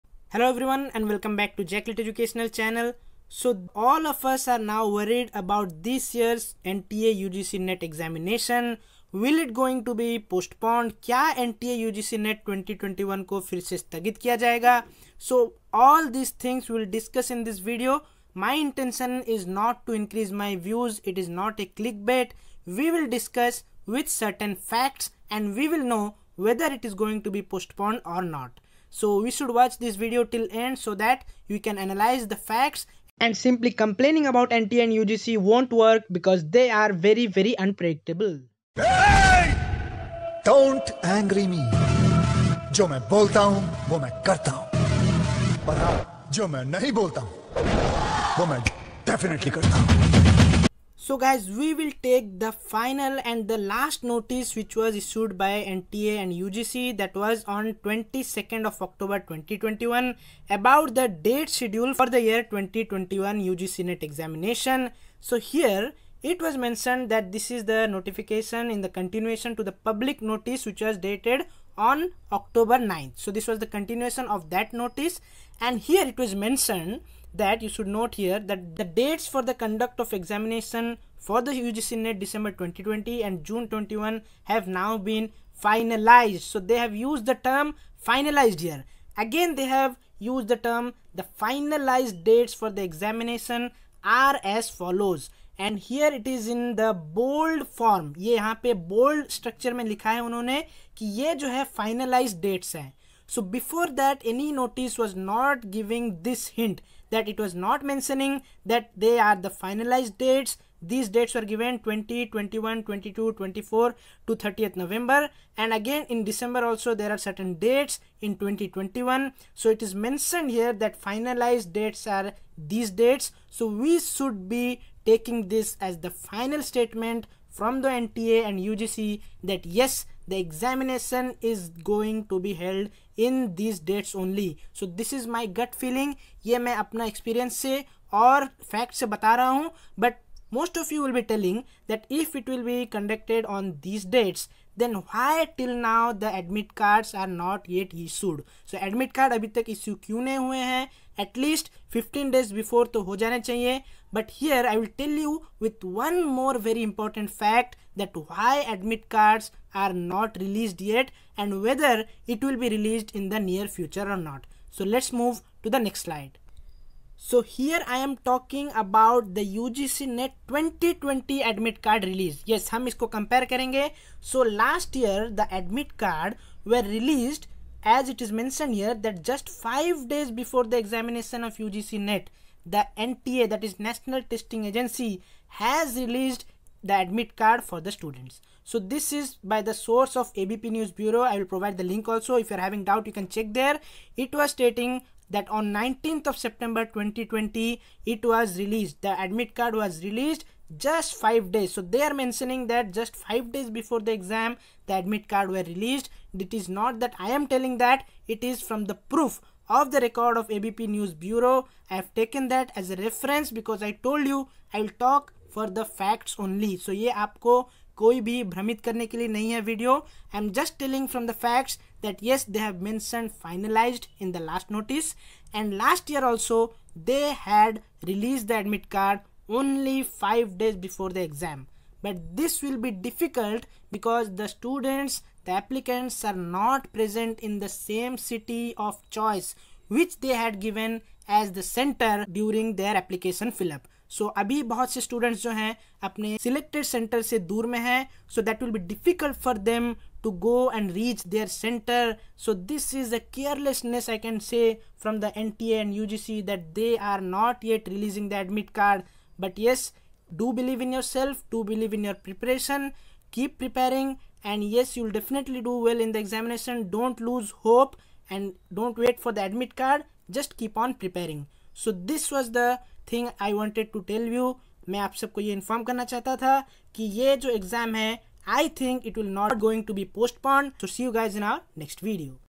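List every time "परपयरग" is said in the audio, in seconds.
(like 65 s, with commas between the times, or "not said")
263 s, 270 s.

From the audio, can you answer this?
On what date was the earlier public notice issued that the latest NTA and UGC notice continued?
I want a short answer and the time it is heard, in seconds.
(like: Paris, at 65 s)
October 9th, at 72 s.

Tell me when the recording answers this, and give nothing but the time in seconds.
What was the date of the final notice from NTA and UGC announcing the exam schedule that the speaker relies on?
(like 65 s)
57 s.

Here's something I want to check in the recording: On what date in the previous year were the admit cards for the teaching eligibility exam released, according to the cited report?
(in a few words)
19th September 2020.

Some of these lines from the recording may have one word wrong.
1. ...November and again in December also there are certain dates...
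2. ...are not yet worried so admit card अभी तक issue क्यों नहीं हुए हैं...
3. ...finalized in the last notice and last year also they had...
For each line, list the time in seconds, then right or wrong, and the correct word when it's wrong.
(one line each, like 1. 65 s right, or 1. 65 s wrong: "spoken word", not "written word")
1. 114 s right
2. 147 s wrong: "issued", not "worried"
3. 223 s right.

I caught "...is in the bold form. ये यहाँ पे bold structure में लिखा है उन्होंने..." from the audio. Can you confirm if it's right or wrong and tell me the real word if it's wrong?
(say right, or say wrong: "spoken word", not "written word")
right.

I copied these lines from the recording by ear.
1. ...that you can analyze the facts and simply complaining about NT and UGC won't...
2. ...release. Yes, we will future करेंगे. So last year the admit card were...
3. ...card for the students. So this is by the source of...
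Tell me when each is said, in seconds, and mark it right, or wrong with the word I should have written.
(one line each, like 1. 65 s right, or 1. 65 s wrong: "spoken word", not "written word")
1. 30 s right
2. 172 s wrong: "compare", not "future"
3. 187 s right.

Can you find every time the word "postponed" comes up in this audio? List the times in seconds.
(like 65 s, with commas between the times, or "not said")
10 s, 27 s.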